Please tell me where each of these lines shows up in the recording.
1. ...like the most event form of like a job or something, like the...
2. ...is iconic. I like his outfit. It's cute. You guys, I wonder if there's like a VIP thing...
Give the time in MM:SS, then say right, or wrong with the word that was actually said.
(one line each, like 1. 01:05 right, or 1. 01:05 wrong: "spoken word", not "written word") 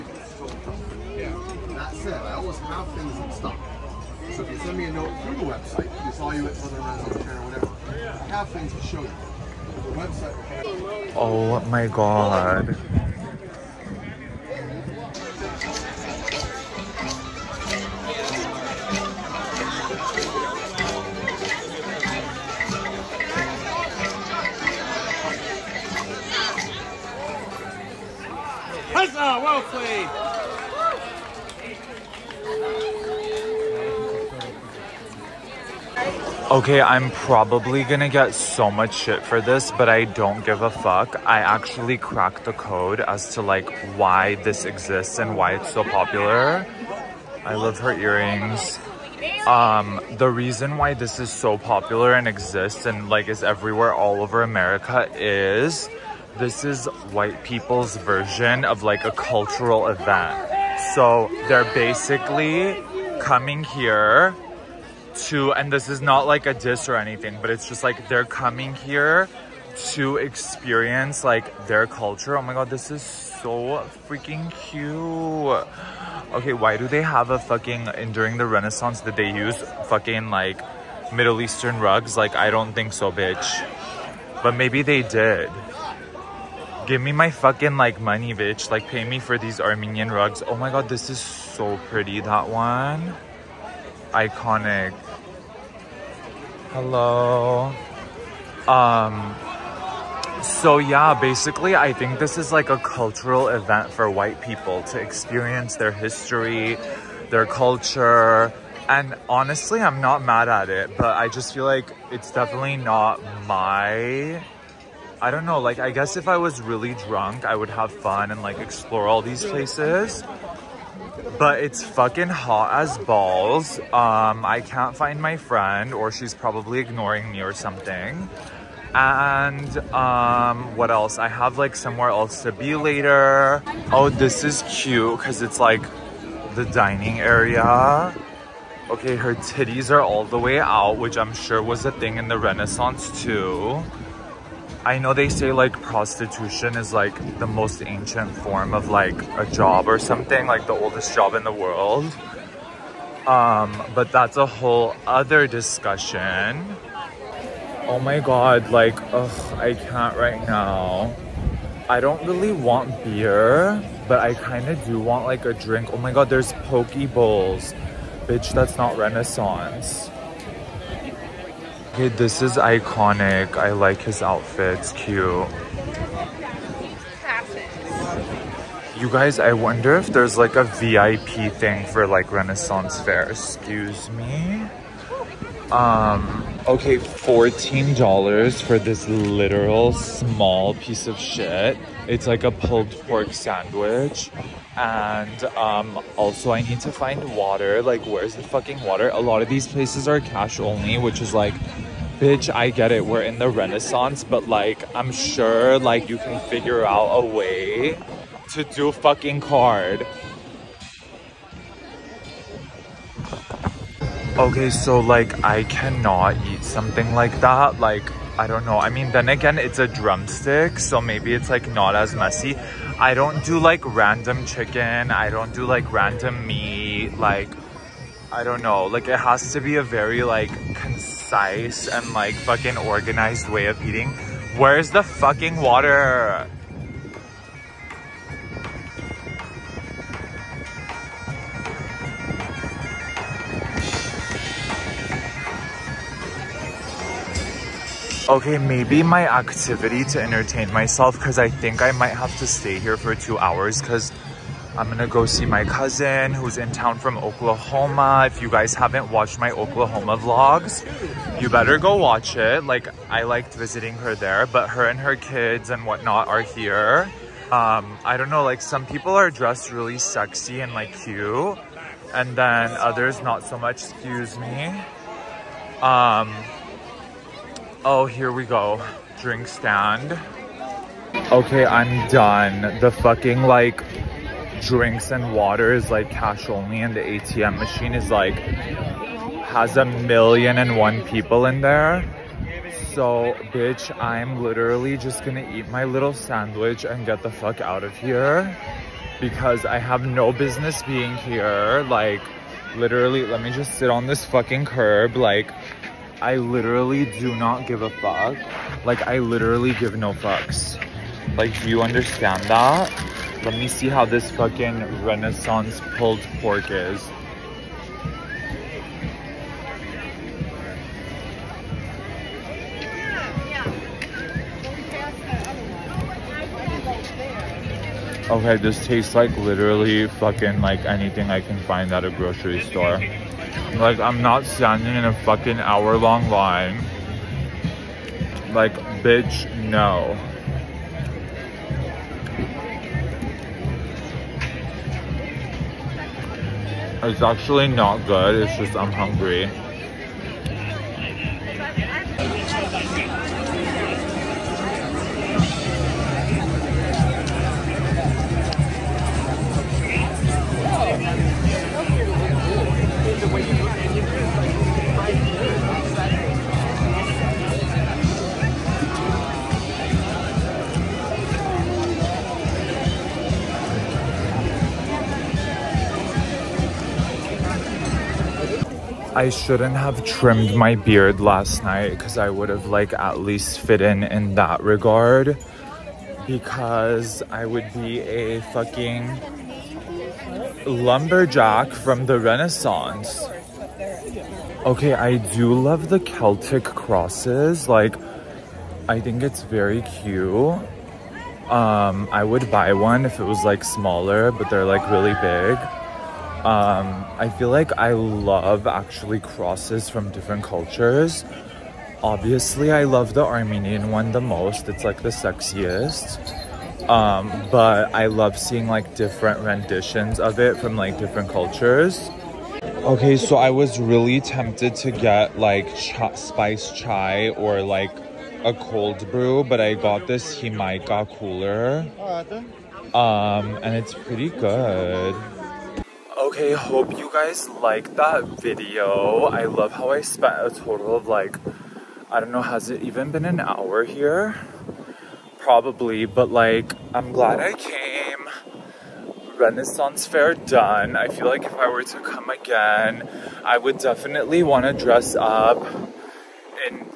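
1. 02:26 wrong: "ancient", not "event"
2. 02:52 right.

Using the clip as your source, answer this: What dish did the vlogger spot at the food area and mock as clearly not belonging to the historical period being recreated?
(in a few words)
Poke bowls.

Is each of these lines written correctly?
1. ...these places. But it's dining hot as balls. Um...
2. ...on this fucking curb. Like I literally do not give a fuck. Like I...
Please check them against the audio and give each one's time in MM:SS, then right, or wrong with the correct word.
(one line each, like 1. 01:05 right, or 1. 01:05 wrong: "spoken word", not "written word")
1. 01:59 wrong: "fucking", not "dining"
2. 05:03 right.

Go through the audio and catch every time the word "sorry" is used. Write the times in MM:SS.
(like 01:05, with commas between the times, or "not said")
not said.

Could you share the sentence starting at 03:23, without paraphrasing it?
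We're in the Renaissance, but like, I'm sure like you can figure out a way to do fucking card.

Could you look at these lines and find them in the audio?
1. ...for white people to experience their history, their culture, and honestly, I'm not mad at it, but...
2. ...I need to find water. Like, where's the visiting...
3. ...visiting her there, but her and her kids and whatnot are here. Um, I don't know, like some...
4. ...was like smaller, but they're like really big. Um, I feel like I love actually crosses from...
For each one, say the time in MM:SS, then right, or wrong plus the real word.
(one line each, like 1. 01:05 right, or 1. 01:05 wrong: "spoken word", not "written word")
1. 01:43 right
2. 03:16 wrong: "fucking", not "visiting"
3. 04:23 right
4. 06:43 right.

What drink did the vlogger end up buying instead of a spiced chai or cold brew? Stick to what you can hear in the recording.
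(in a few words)
Jamaica cooler.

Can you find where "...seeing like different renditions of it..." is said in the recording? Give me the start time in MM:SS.
06:58.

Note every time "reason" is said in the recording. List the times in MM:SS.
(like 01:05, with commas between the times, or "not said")
00:50.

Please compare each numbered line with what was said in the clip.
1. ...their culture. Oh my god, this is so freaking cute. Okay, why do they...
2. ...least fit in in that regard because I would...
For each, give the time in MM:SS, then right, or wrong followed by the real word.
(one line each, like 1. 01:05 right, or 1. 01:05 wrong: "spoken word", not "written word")
1. 01:11 right
2. 06:23 right.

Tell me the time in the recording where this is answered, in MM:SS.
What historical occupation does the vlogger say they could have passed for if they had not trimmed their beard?
06:30.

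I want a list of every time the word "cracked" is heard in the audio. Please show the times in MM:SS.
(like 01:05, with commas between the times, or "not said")
00:41.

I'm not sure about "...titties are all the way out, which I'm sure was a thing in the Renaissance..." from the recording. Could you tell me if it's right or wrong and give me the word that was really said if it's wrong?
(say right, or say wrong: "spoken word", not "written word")
right.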